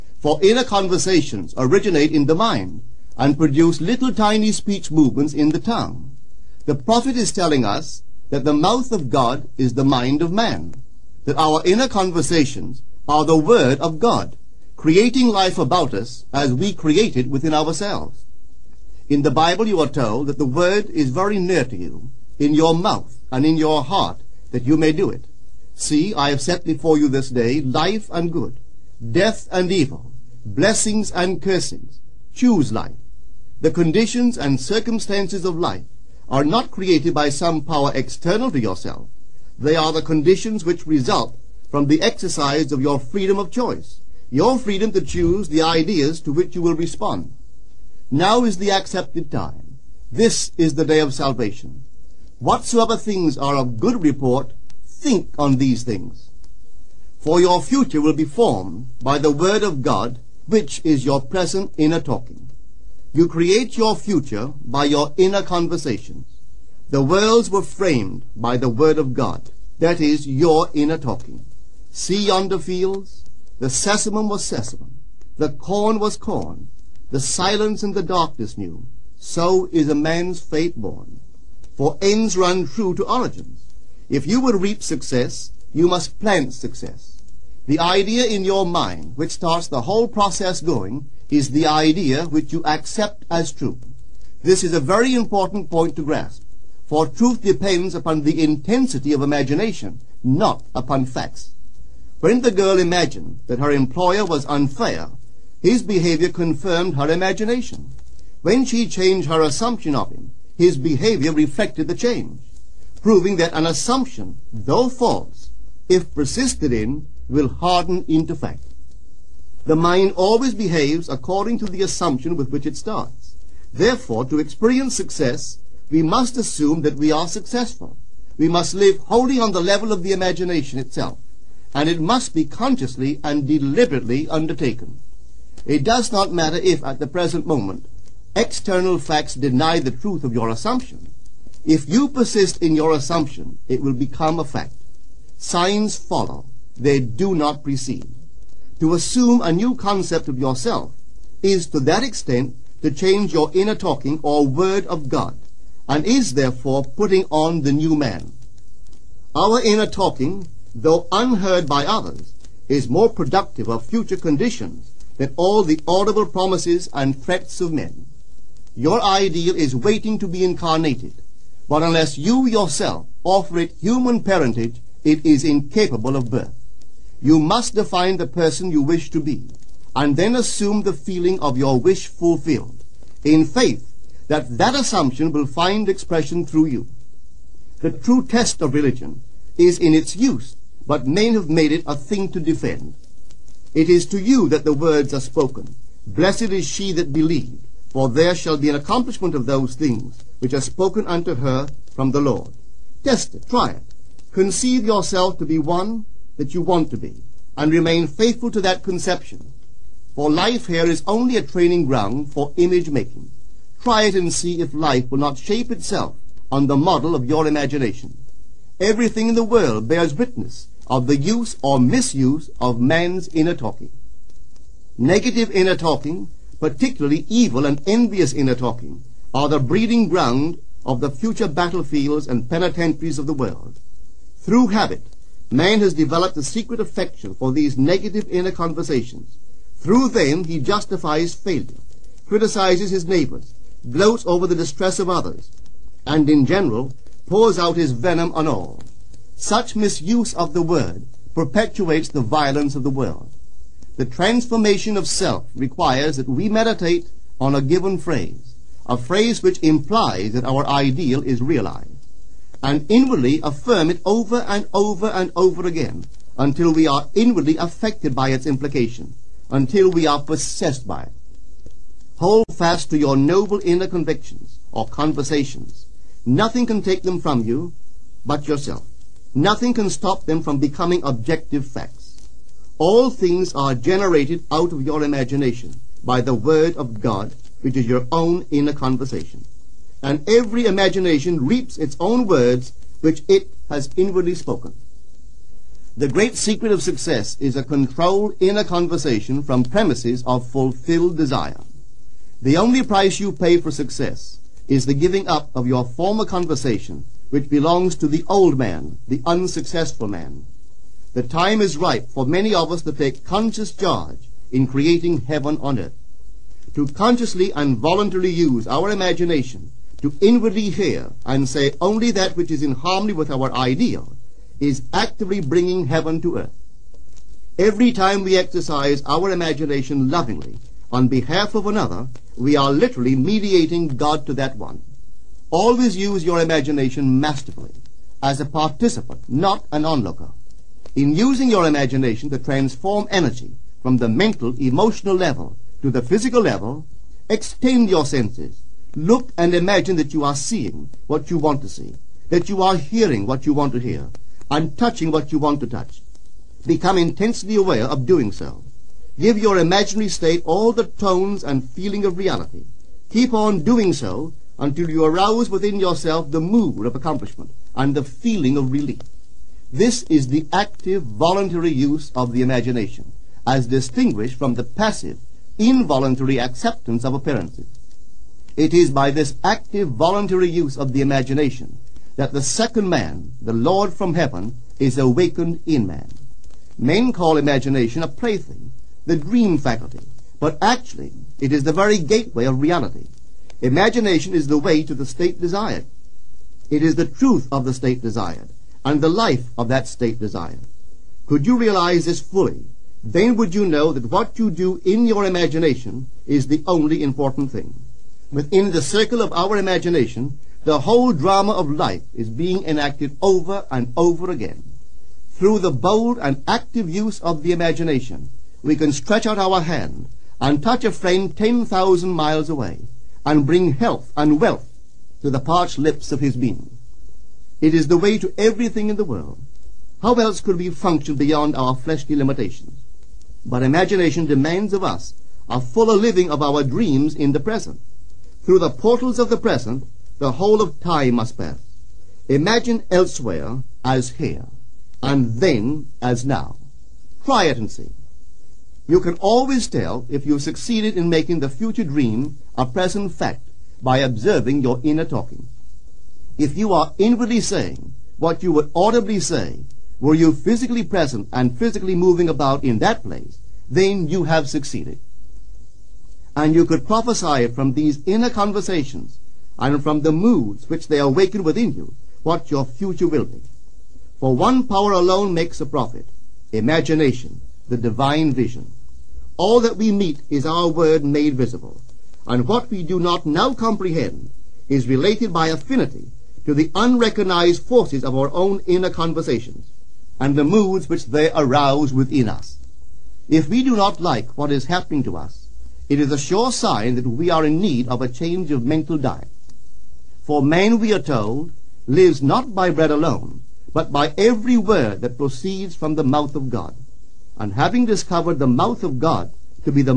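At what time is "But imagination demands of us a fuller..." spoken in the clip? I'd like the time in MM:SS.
07:13.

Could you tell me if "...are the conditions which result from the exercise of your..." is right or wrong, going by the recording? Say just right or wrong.
right.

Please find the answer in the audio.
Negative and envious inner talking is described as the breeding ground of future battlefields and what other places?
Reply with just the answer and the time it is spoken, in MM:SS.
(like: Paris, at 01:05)
Penitentiaries, at 03:52.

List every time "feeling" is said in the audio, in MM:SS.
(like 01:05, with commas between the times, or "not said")
03:00, 06:01, 06:08.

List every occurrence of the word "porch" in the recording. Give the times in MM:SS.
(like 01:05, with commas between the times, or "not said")
not said.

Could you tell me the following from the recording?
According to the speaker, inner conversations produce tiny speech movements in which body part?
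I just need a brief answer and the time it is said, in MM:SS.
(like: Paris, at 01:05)
The tongue, at 00:05.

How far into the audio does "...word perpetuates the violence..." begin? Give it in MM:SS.
04:10.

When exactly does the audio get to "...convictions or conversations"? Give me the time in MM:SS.
04:33.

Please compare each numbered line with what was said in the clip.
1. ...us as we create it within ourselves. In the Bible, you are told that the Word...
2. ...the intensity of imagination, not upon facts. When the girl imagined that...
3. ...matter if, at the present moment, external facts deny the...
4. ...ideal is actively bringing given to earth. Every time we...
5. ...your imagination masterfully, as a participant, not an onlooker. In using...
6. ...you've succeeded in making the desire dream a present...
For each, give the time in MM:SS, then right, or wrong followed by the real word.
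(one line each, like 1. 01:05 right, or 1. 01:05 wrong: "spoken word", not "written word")
1. 00:15 right
2. 01:38 right
3. 02:16 right
4. 05:23 wrong: "heaven", not "given"
5. 05:36 right
6. 07:30 wrong: "future", not "desire".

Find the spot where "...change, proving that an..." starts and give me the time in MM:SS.
01:51.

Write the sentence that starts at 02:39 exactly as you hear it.
Our inner talking, though unheard by others, is more productive of future conditions than all the audible promises and threats of men.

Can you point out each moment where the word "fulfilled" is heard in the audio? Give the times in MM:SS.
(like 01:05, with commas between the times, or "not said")
03:02, 05:00.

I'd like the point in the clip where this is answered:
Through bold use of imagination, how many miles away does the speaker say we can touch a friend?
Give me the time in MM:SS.
07:01.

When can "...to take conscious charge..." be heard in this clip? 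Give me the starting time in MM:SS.
05:12.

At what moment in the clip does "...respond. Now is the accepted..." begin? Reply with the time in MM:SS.
00:46.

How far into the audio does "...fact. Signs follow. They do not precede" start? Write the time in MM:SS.
02:24.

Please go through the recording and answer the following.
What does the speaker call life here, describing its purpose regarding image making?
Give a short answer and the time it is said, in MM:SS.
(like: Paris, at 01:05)
A training ground, at 03:31.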